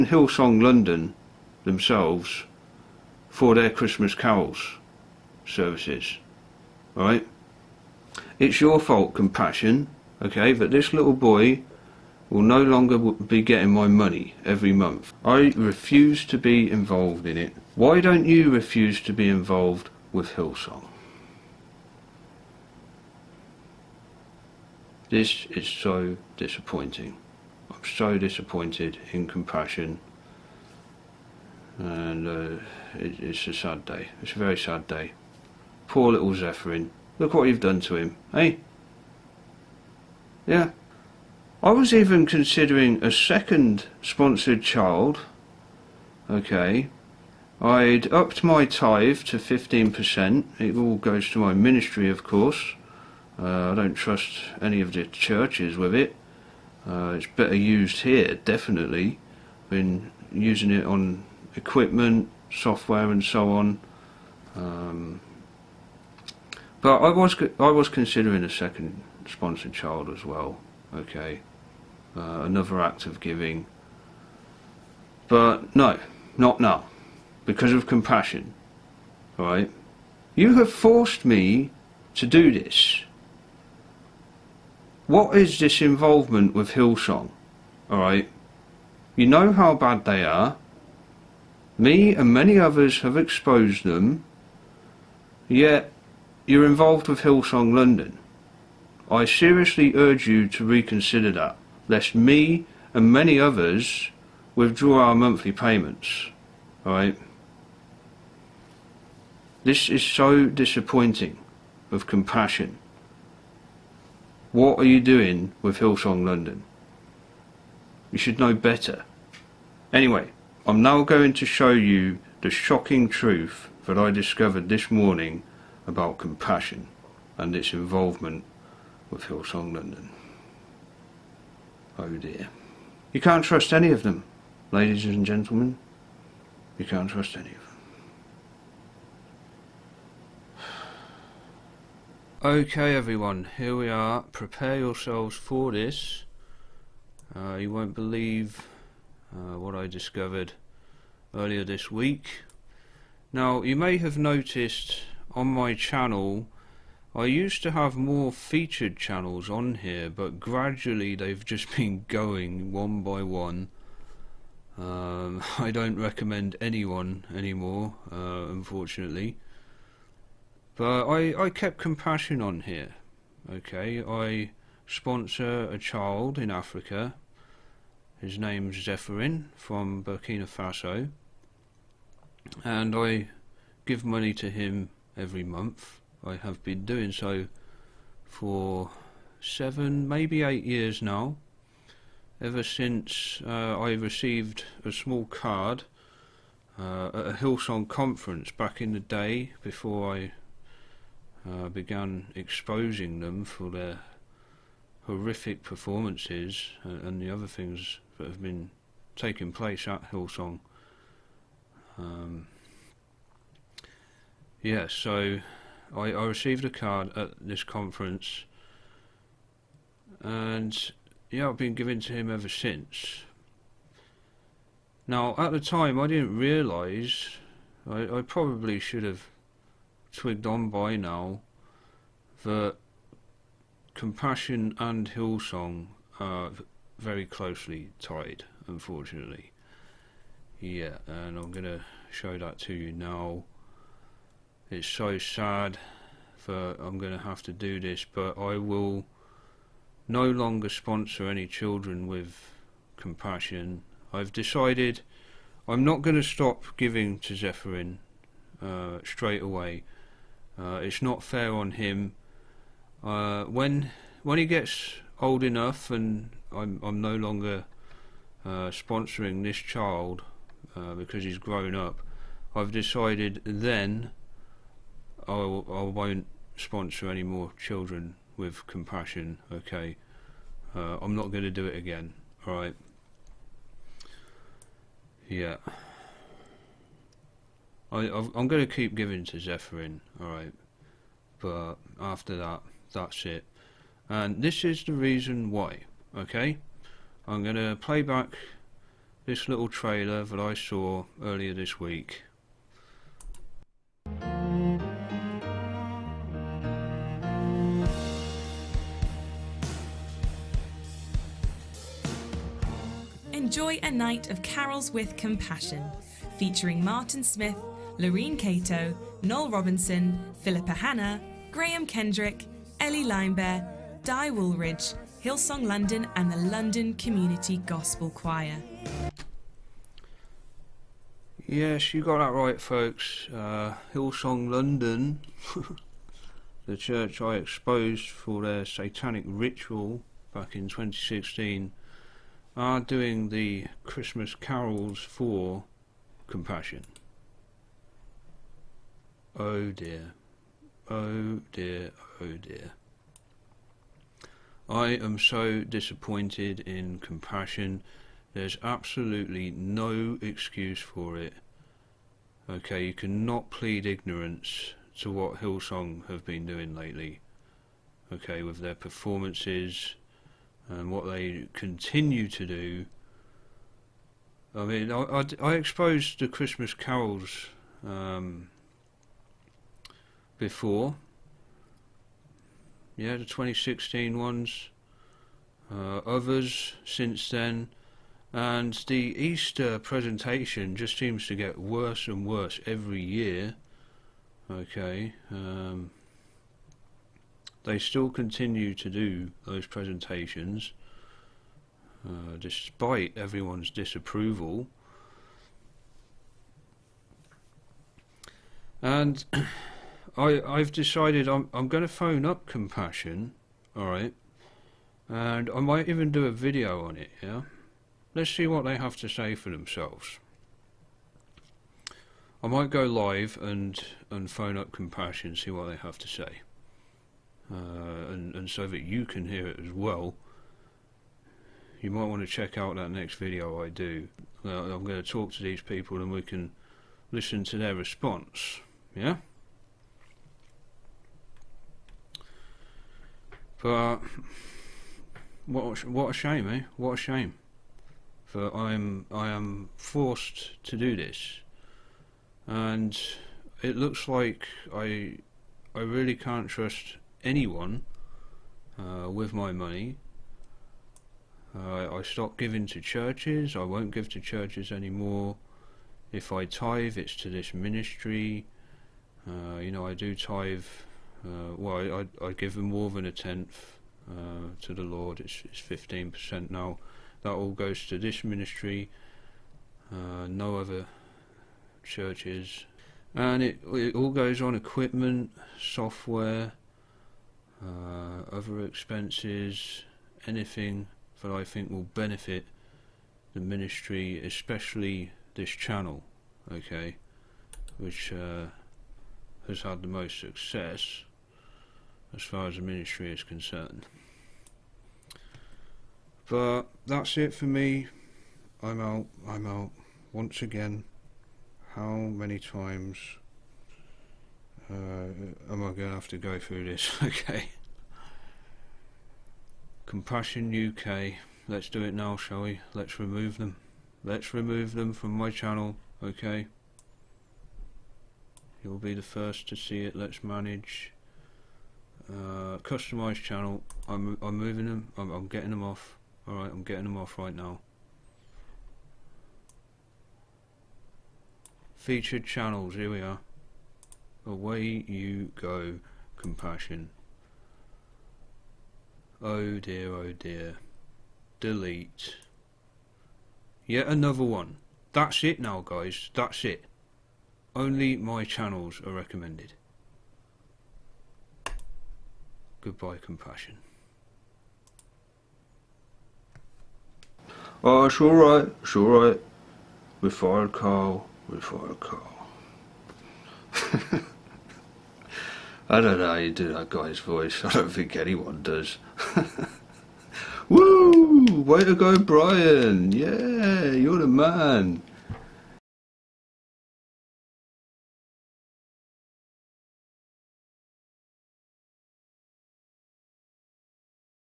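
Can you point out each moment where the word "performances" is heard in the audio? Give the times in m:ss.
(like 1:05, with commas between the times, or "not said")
3:25, 6:08.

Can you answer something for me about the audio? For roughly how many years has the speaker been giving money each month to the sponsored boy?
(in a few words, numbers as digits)
7 or 8 years.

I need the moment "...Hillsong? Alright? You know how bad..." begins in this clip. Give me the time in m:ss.
1:26.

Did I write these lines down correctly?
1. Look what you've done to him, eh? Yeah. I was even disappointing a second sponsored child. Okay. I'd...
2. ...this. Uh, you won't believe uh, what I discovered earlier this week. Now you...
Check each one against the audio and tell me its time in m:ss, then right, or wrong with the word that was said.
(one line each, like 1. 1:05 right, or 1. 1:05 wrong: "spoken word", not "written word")
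1. 0:37 wrong: "considering", not "disappointing"
2. 2:25 right.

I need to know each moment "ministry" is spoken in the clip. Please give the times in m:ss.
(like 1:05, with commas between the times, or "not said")
0:51, 7:47, 7:58, 8:13, 8:22.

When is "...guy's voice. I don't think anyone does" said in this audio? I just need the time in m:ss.
9:36.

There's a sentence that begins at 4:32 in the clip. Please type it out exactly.
I've decided then I will, I won't sponsor any more children with compassion.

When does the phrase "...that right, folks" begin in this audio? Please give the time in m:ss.
5:32.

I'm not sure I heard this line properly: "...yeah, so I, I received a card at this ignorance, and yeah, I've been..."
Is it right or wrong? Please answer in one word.
wrong.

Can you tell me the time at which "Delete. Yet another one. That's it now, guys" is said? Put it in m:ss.
9:11.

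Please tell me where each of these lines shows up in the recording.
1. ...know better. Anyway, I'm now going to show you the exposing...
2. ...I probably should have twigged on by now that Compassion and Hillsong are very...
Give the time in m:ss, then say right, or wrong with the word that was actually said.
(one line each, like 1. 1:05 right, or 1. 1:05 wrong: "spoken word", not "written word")
1. 1:58 wrong: "shocking", not "exposing"
2. 3:48 right.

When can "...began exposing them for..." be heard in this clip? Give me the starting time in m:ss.
3:21.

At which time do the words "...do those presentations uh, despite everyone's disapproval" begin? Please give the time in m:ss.
6:38.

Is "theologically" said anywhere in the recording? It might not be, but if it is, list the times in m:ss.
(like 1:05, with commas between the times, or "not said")
not said.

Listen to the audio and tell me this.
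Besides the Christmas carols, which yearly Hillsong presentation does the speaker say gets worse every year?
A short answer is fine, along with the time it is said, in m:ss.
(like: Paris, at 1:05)
Easter presentation, at 6:29.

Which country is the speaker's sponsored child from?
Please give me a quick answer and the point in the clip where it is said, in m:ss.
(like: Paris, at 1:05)
Burkina Faso, at 3:00.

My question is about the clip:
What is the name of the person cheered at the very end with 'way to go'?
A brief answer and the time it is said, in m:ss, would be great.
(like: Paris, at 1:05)
Brian, at 9:41.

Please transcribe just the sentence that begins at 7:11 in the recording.
You might want to check out that next video I do.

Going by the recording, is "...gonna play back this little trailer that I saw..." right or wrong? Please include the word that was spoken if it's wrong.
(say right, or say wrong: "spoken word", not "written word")
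right.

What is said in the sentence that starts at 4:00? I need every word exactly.
Yeah, and I'm going to show that to you now.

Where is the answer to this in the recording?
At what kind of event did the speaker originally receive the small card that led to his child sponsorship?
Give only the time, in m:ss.
3:17.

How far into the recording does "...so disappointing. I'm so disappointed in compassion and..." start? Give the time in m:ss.
0:25.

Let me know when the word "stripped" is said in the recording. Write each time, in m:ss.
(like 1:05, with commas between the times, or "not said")
not said.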